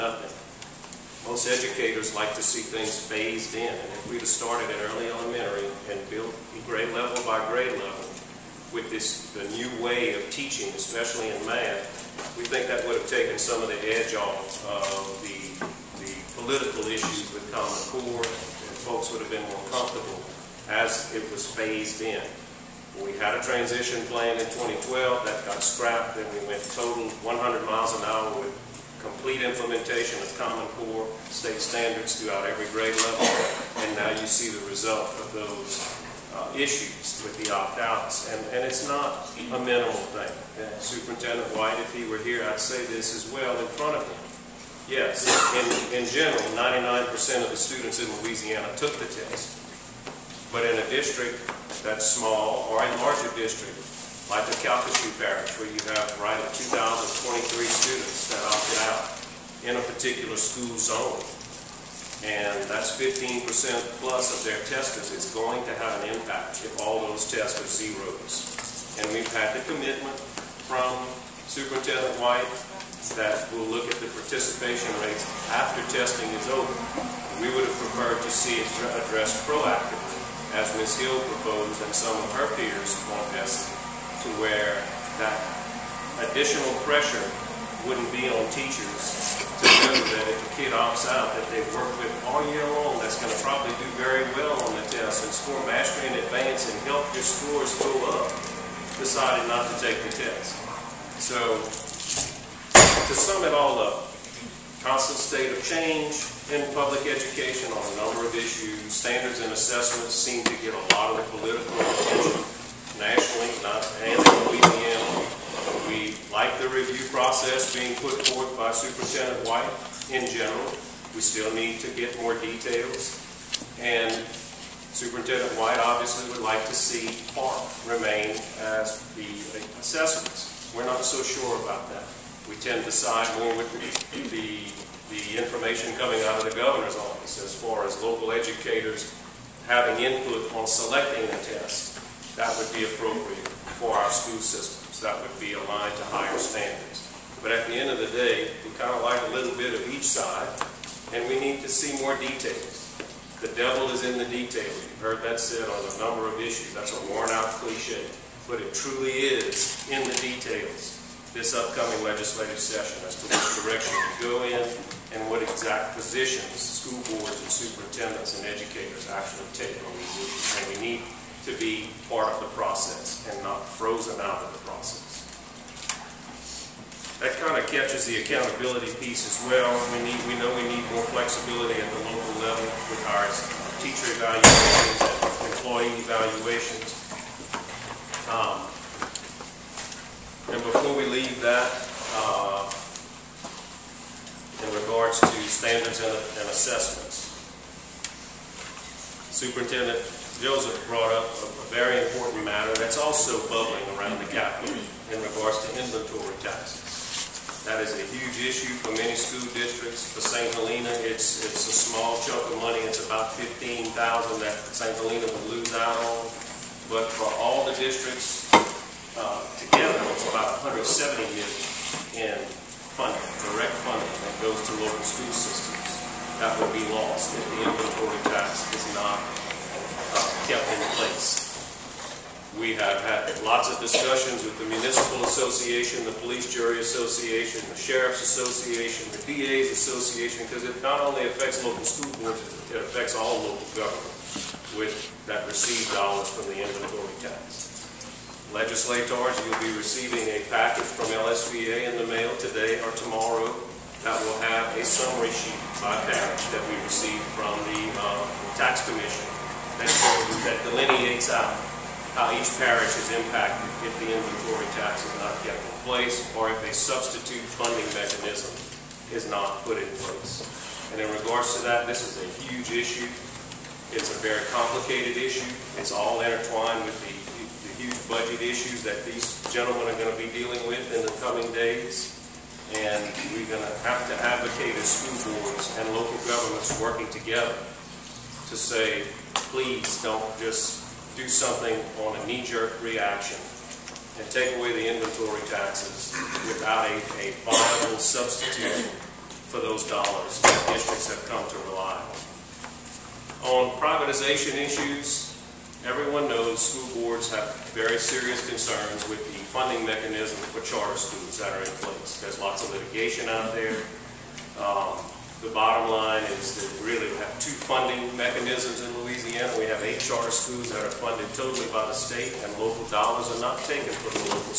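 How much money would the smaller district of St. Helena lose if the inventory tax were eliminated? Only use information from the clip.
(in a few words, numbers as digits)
15000.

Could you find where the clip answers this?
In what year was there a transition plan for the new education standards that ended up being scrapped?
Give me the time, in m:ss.
0:24.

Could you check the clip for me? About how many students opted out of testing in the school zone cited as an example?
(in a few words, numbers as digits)
2,023.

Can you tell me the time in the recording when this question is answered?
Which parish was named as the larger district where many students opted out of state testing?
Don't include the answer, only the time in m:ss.
0:54.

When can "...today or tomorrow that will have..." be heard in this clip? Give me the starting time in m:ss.
4:12.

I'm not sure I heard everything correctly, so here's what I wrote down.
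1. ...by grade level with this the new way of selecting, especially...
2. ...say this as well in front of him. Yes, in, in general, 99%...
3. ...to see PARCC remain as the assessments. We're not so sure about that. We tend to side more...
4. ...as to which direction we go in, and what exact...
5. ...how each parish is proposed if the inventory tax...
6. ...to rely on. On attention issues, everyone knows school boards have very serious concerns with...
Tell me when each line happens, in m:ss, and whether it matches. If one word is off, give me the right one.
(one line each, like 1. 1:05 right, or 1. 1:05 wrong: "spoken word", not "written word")
1. 0:07 wrong: "teaching", not "selecting"
2. 0:42 right
3. 2:06 right
4. 2:43 right
5. 4:22 wrong: "impacted", not "proposed"
6. 5:01 wrong: "privatization", not "attention".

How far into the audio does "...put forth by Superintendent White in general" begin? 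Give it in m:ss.
1:58.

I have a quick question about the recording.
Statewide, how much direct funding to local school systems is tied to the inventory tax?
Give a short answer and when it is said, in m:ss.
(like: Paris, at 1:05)
170 million, at 3:40.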